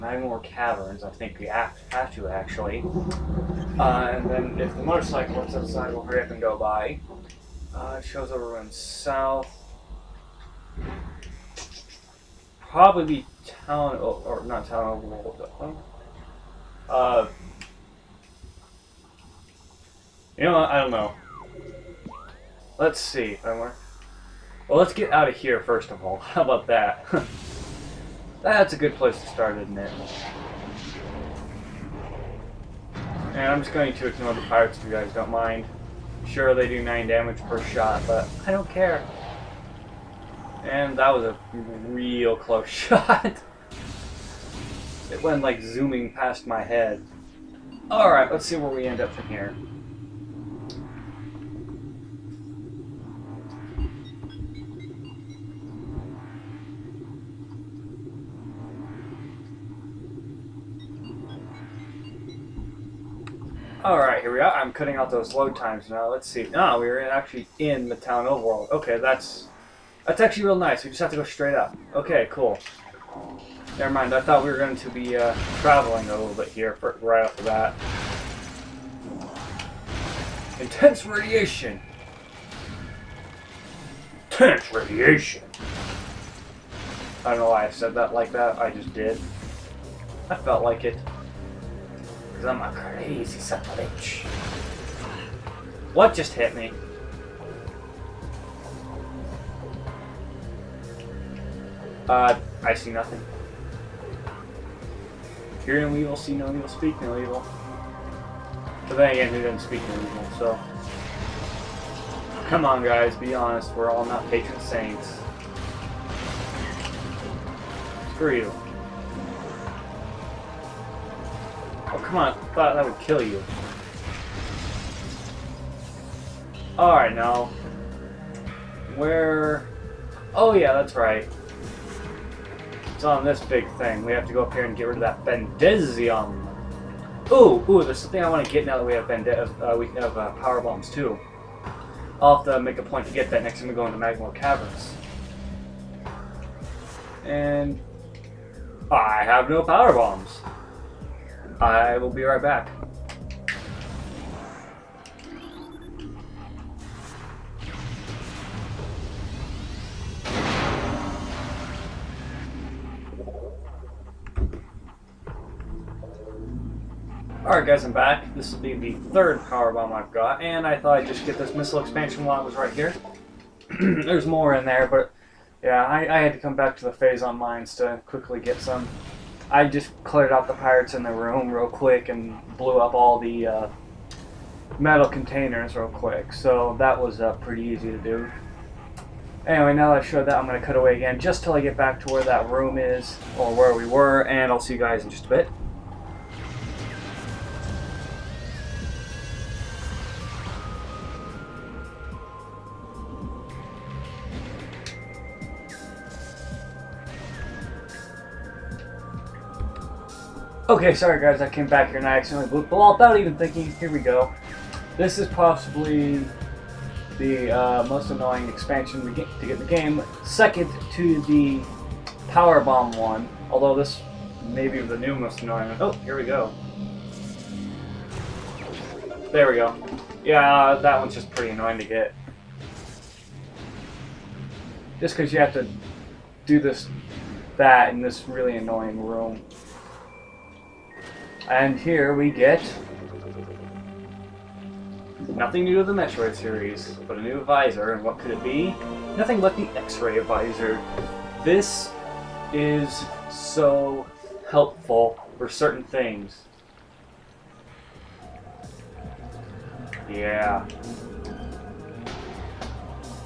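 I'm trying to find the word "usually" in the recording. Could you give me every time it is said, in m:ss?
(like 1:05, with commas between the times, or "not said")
not said.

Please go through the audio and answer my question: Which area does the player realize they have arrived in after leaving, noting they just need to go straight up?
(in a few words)
Tallon Overworld.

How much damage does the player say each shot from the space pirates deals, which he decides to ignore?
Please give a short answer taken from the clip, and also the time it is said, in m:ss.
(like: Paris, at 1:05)
9, at 0:36.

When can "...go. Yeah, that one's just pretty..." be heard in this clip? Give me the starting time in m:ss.
3:49.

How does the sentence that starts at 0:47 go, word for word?
Alright, let's see where we end up from here.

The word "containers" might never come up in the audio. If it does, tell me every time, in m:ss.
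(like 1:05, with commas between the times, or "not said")
3:05.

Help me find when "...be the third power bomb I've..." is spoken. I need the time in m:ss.
2:48.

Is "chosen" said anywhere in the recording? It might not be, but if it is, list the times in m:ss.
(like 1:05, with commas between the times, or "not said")
not said.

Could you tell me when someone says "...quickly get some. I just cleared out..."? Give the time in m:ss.
2:58.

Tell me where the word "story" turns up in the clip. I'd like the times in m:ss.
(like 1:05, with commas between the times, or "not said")
not said.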